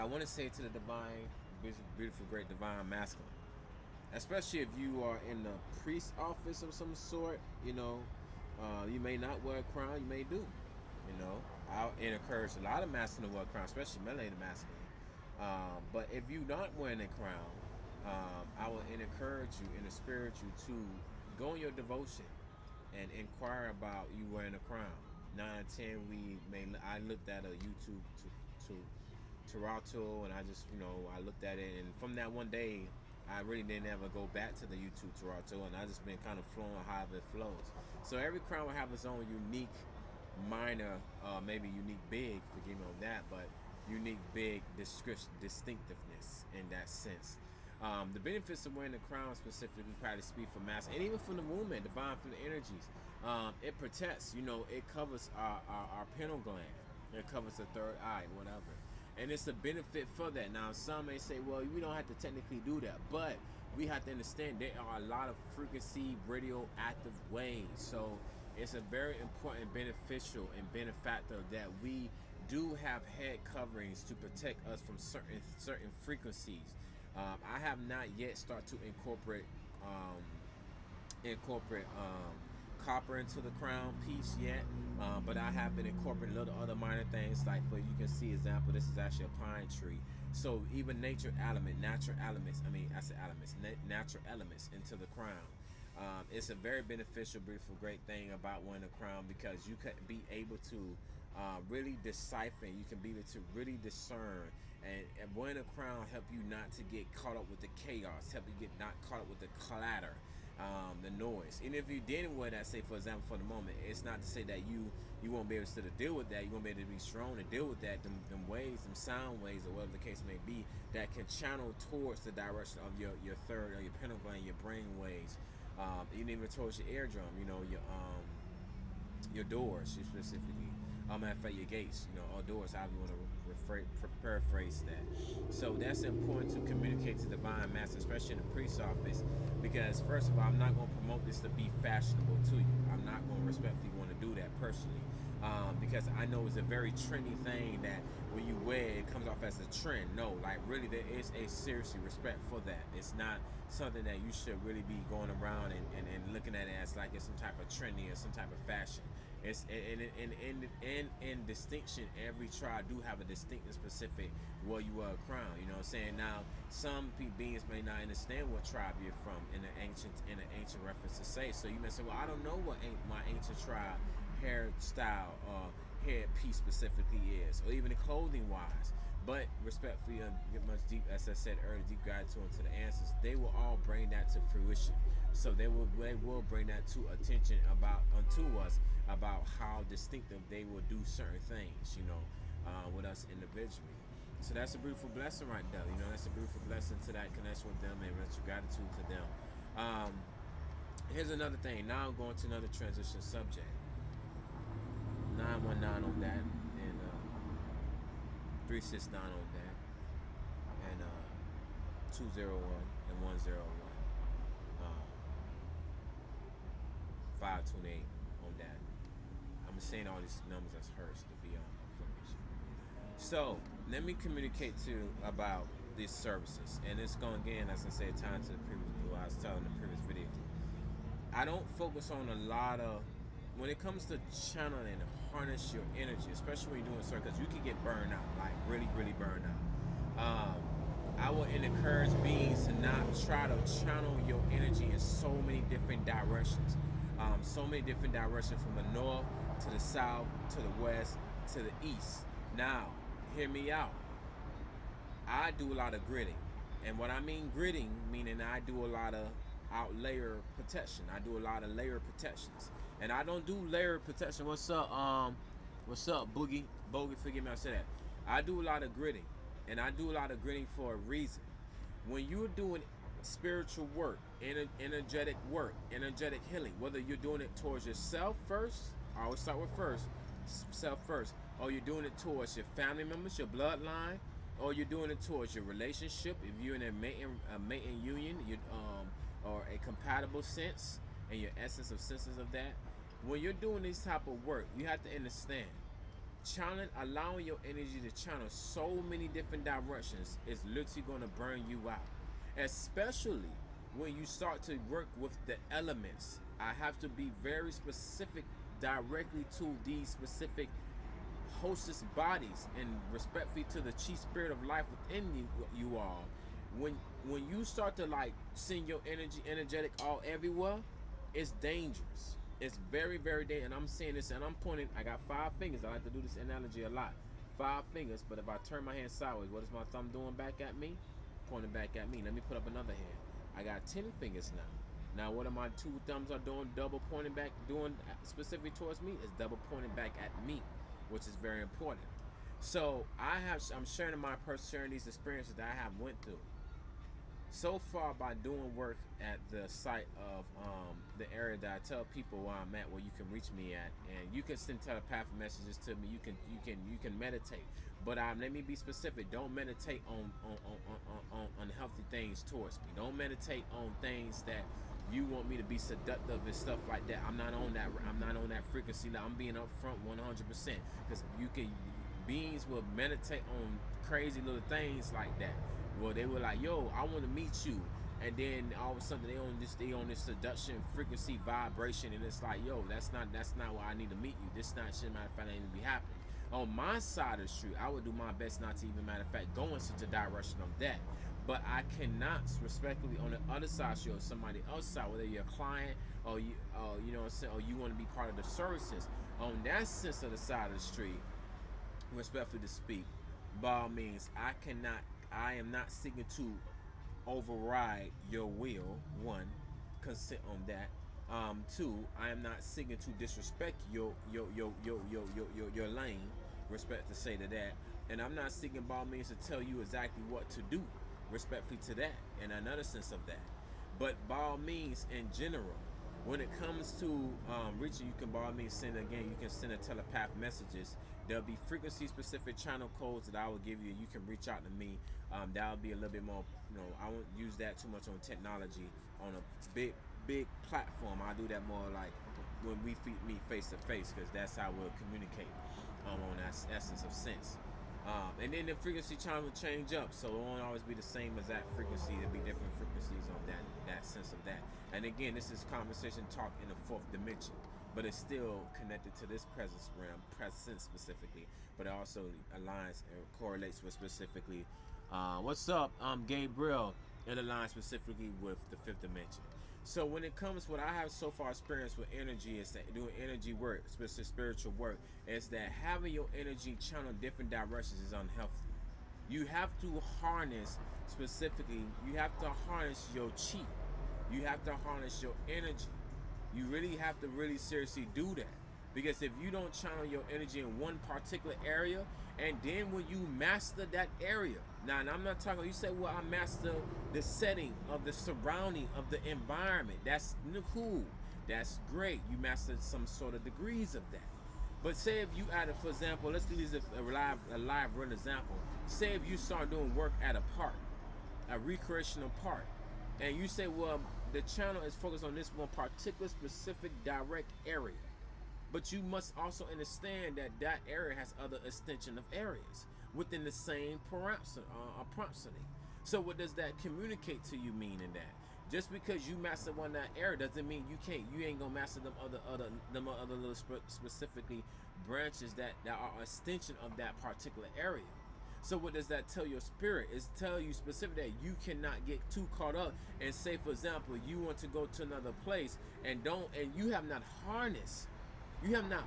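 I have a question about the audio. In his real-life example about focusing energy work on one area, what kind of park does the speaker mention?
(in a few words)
recreational park.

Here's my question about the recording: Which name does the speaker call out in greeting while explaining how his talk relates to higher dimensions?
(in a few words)
Gabriel.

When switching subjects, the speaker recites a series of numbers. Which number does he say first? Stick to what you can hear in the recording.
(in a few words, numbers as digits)
919.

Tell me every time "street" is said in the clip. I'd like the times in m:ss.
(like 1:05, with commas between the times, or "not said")
6:27, 6:40.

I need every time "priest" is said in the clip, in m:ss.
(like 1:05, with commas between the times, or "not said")
0:05, 2:18.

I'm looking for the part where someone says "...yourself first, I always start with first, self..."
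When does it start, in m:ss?
4:37.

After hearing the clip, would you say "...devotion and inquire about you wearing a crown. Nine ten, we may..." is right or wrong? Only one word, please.
right.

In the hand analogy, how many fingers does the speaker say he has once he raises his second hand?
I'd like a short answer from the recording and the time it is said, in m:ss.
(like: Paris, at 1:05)
10, at 5:33.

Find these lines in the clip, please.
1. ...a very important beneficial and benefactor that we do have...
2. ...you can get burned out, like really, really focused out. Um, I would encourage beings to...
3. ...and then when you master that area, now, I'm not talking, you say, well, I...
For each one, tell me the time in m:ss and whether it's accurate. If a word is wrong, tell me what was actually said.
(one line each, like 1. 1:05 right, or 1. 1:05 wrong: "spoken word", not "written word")
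1. 1:08 right
2. 3:57 wrong: "burned", not "focused"
3. 8:12 right.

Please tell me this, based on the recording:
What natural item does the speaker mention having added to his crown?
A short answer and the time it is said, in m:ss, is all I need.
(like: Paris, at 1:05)
pine tree, at 1:29.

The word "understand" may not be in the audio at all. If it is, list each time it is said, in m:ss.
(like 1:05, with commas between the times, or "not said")
1:04, 2:48, 4:55, 8:39.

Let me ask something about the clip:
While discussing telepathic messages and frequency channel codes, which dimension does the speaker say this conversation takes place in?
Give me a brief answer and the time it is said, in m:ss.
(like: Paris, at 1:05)
fourth dimension, at 7:36.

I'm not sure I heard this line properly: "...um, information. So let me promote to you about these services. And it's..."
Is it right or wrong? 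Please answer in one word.
wrong.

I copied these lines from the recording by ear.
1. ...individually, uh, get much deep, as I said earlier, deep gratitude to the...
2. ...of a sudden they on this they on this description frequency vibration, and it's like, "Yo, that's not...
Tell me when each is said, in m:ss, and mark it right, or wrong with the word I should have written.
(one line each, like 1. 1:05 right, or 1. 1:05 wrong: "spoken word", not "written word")
1. 2:59 wrong: "respectfully", not "individually"
2. 6:18 wrong: "seduction", not "description".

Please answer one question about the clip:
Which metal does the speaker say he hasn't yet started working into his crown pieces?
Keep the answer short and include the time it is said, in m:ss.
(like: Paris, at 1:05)
copper, at 1:22.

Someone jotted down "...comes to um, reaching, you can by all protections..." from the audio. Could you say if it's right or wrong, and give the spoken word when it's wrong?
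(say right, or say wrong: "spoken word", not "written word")
wrong: "means", not "protections".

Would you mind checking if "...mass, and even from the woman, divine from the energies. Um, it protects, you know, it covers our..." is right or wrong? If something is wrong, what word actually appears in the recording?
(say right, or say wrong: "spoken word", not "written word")
right.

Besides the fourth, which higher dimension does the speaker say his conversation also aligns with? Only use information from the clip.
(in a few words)
fifth dimension.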